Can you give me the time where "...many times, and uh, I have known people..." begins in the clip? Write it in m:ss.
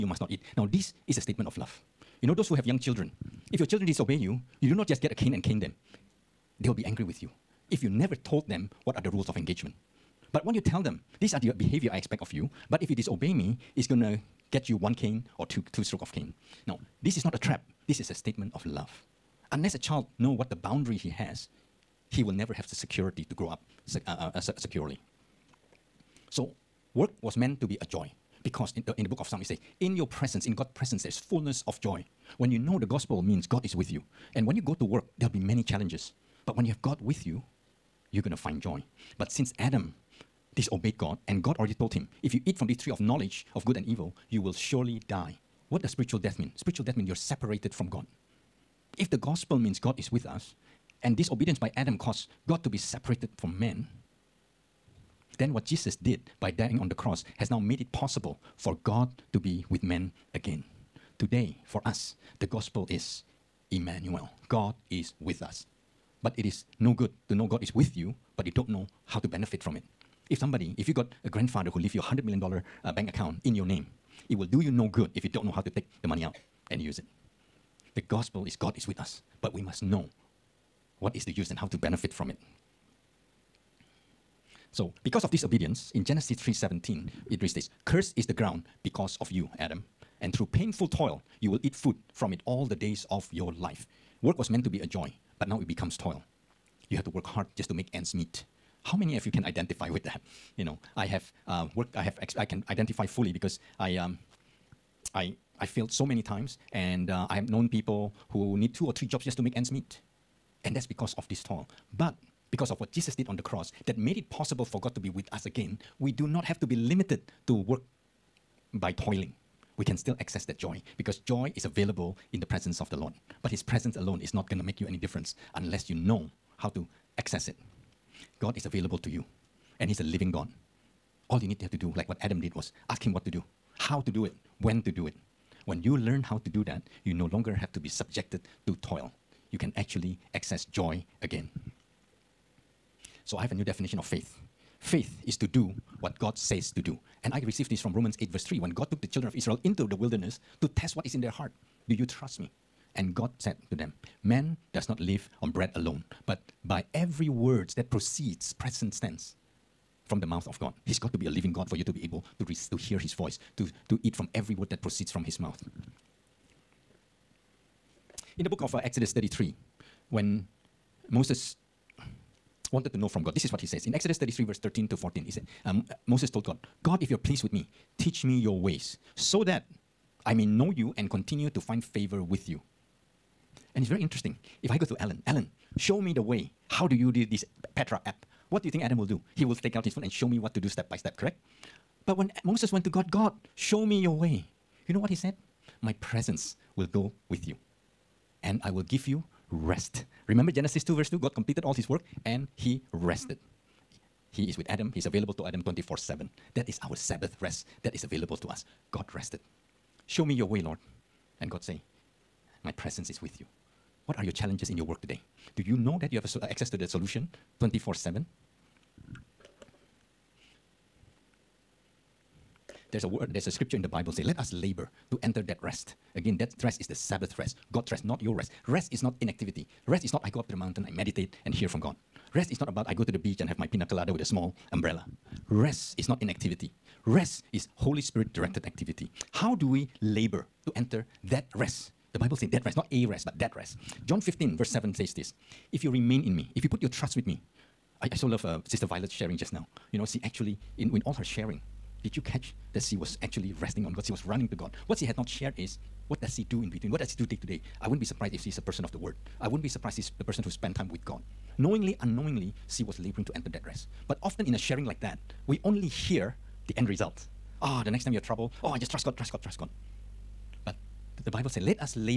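1:46.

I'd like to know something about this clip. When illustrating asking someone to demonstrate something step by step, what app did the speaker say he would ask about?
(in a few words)
Petra.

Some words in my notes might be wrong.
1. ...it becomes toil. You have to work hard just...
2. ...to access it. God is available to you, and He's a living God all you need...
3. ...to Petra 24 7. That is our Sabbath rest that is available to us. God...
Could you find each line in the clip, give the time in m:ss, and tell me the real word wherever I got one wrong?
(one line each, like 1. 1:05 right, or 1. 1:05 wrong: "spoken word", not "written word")
1. 1:35 right
2. 2:06 right
3. 3:25 wrong: "Adam", not "Petra".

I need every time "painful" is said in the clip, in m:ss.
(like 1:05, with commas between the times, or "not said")
1:30.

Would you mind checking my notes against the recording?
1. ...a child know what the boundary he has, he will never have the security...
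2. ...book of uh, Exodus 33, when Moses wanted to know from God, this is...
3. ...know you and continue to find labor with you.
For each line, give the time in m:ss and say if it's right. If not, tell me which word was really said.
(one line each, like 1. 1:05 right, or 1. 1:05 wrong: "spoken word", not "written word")
1. 0:19 right
2. 2:48 right
3. 3:00 wrong: "favor", not "labor".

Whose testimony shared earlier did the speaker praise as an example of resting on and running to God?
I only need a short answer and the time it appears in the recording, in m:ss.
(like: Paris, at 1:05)
Sister Violet, at 4:08.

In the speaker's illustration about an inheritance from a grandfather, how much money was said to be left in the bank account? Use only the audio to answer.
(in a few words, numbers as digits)
$100 million.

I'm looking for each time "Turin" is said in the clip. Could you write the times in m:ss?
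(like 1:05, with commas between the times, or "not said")
not said.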